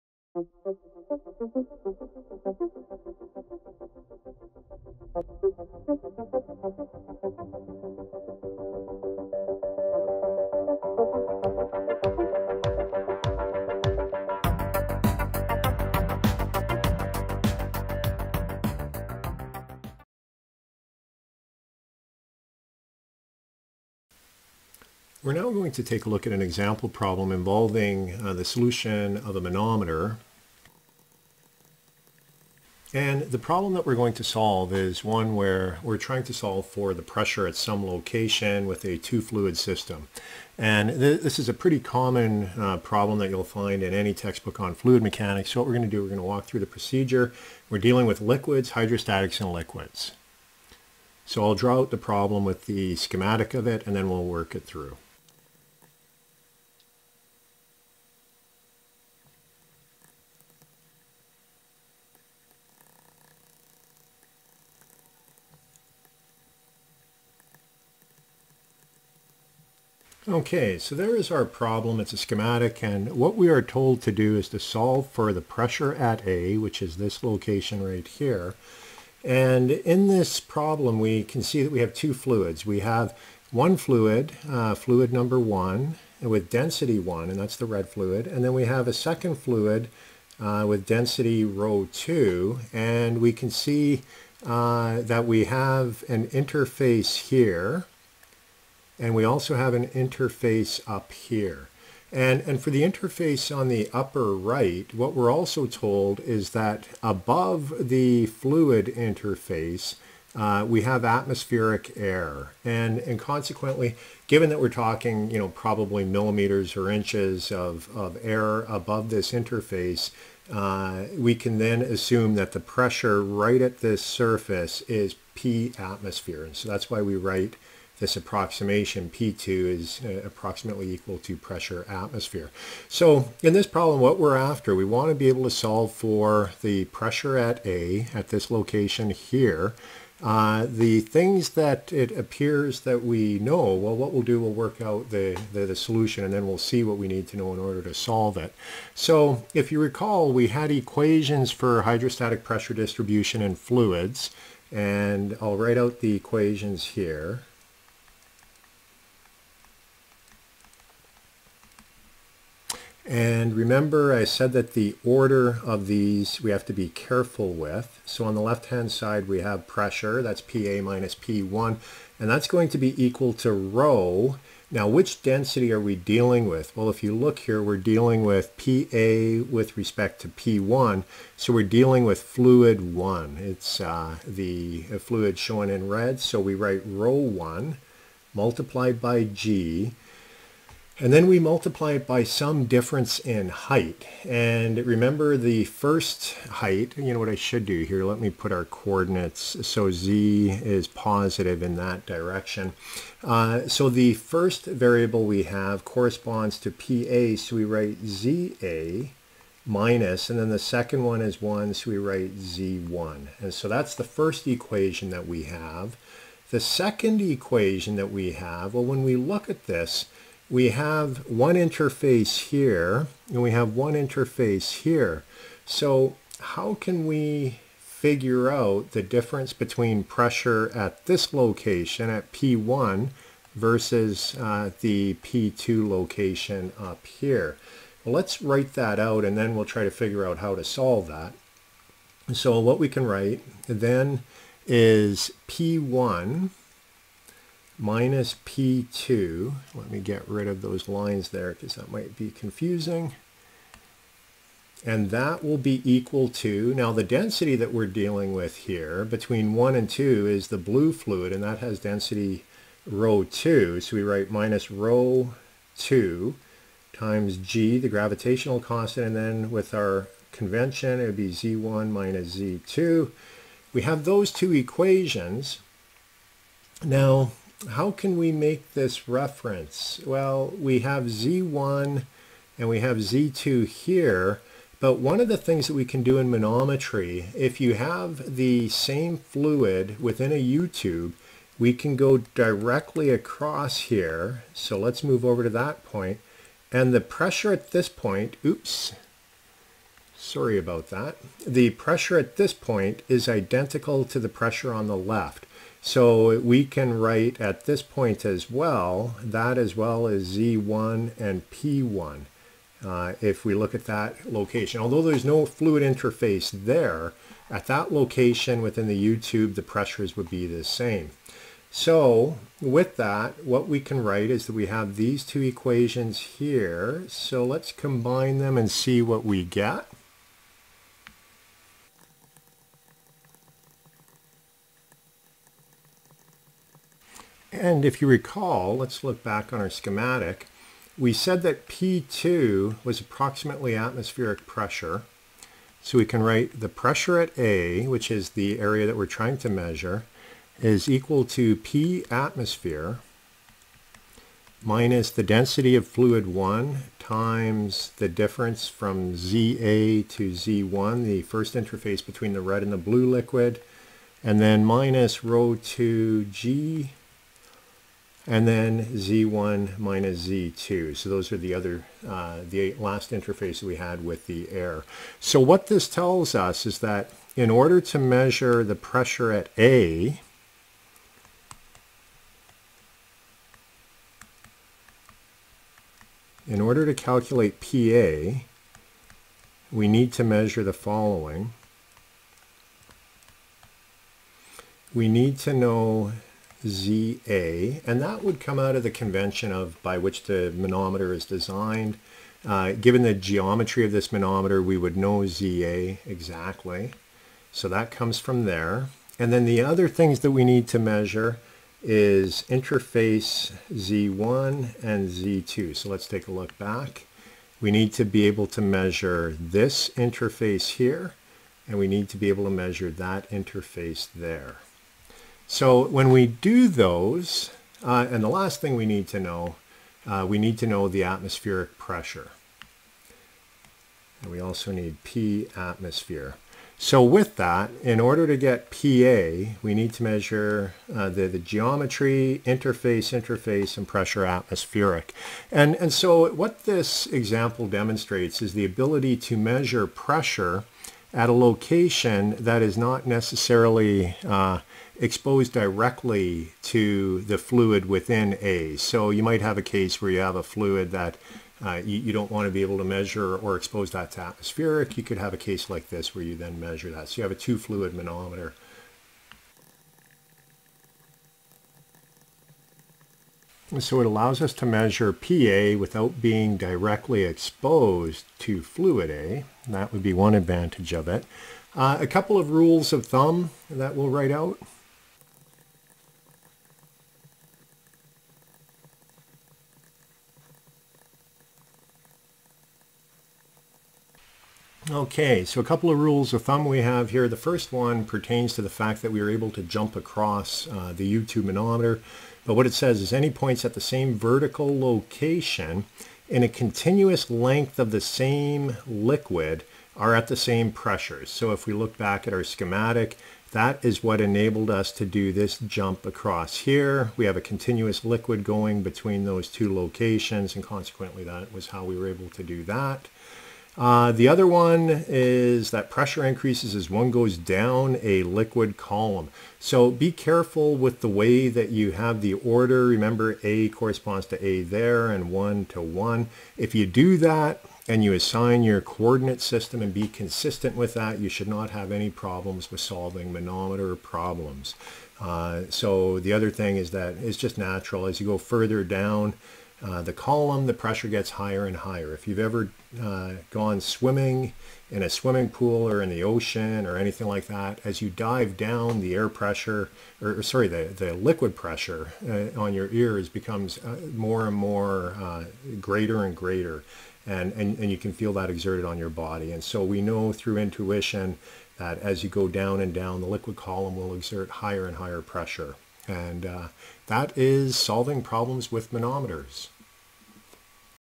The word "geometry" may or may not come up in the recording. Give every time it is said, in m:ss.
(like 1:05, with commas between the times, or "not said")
6:43, 7:21.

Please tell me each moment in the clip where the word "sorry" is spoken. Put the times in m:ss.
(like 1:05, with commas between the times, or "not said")
5:00, 9:20.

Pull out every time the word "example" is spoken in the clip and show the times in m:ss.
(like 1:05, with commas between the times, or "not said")
0:26, 7:27.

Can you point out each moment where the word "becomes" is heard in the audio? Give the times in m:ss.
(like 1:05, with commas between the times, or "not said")
9:23.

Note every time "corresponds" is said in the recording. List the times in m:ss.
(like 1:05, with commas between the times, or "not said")
3:25, 8:53.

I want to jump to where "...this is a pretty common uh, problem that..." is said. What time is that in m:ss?
0:41.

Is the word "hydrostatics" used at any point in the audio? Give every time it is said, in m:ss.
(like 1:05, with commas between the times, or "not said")
0:48, 2:31.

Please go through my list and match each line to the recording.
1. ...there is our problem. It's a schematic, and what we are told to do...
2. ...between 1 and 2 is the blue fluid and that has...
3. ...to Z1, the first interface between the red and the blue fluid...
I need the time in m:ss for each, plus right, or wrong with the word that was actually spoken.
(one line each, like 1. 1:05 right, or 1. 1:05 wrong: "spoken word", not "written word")
1. 1:10 right
2. 4:19 right
3. 6:00 wrong: "liquid", not "fluid".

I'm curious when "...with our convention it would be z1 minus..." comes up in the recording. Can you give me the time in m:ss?
4:29.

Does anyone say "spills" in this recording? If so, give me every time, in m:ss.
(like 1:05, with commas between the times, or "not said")
not said.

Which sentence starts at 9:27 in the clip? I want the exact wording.
And, and, and you can feel that exerted on your body.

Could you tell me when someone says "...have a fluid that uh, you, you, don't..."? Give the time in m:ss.
7:40.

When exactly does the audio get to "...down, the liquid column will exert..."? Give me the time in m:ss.
9:32.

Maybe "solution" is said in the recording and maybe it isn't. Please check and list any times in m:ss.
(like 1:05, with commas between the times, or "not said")
0:28, 2:25.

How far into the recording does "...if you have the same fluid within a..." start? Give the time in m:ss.
4:47.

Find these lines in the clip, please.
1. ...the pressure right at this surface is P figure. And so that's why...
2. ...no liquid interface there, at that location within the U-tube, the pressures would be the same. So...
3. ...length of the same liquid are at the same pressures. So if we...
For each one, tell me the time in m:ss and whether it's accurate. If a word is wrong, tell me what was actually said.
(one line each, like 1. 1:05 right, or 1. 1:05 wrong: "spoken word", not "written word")
1. 2:02 wrong: "atmosphere", not "figure"
2. 5:15 wrong: "fluid", not "liquid"
3. 8:27 right.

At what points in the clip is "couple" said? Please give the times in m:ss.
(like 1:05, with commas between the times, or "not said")
8:02, 8:15.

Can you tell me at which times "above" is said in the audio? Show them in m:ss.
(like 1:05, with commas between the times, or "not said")
1:47, 1:58.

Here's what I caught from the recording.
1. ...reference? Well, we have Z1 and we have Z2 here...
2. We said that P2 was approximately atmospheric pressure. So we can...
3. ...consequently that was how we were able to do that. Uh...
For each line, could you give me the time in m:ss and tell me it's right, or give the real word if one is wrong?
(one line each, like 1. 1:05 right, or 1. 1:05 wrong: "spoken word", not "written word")
1. 4:39 right
2. 5:40 right
3. 8:40 right.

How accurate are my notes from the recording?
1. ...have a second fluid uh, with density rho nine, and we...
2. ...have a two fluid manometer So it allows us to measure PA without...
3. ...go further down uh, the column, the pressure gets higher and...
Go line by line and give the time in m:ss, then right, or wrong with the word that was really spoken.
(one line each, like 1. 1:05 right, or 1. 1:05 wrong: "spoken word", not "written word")
1. 1:28 wrong: "two", not "nine"
2. 7:47 right
3. 9:08 right.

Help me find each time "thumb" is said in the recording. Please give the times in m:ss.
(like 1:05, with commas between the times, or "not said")
8:03, 8:16.